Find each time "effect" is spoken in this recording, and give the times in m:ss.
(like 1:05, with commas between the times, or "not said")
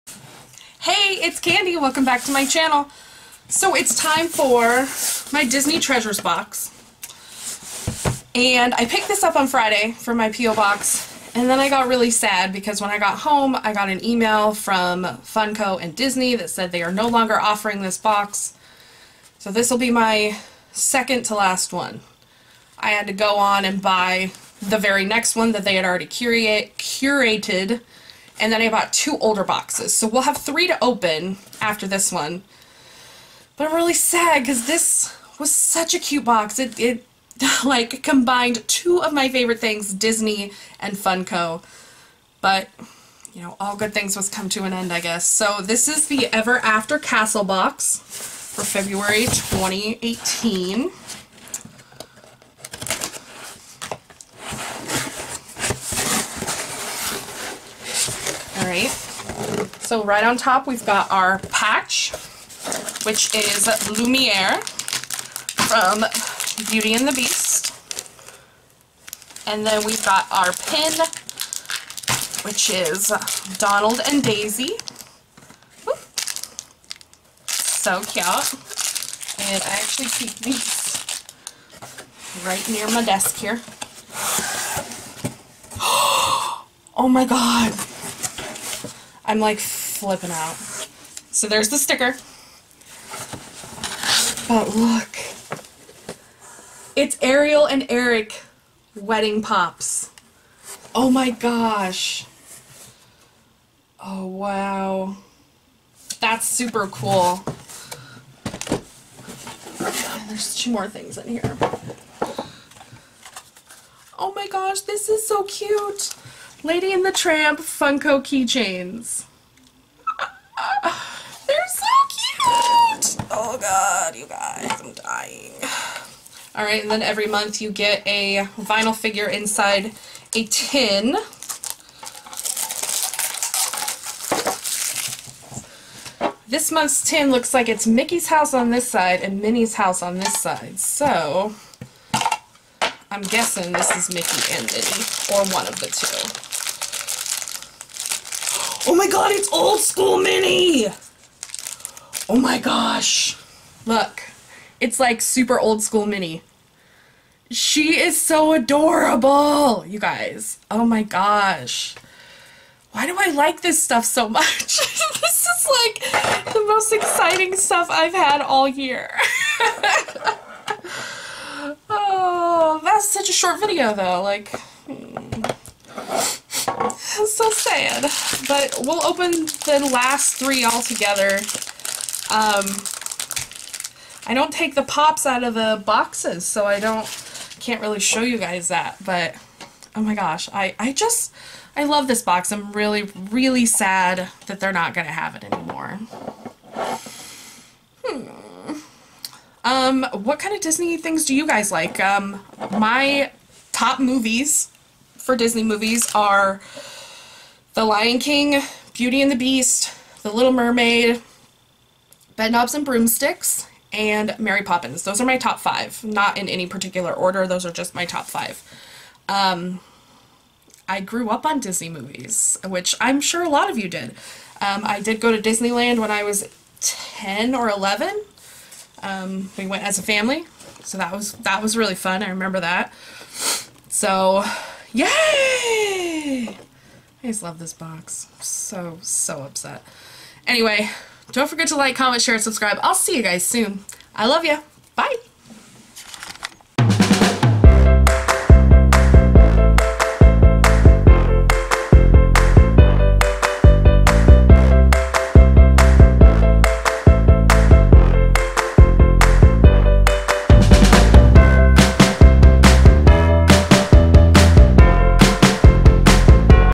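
not said.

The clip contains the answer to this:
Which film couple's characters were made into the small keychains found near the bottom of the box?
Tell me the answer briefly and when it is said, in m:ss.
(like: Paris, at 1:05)
Lady and the Tramp, at 1:56.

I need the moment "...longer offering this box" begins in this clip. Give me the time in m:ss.
0:17.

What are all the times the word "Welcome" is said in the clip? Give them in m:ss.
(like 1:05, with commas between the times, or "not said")
0:01.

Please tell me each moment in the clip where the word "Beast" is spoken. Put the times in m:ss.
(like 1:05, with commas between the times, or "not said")
1:07, 3:29.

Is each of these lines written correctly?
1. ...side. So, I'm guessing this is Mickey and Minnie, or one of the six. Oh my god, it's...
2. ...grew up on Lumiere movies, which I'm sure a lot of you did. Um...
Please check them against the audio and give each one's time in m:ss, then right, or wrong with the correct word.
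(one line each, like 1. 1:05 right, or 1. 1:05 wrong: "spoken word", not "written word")
1. 2:20 wrong: "two", not "six"
2. 3:40 wrong: "Disney", not "Lumiere".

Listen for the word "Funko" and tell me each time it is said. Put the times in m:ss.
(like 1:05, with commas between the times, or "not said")
0:15, 0:40, 1:57.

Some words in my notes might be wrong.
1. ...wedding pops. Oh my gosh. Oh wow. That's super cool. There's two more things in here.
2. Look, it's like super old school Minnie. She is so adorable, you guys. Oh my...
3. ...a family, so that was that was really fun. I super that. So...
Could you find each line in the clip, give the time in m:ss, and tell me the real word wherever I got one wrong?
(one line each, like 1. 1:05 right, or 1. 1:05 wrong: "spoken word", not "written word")
1. 1:38 right
2. 2:33 right
3. 3:49 wrong: "remember", not "super".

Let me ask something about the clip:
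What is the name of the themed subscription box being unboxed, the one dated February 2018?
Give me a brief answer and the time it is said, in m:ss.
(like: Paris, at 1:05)
Ever After Castle, at 0:46.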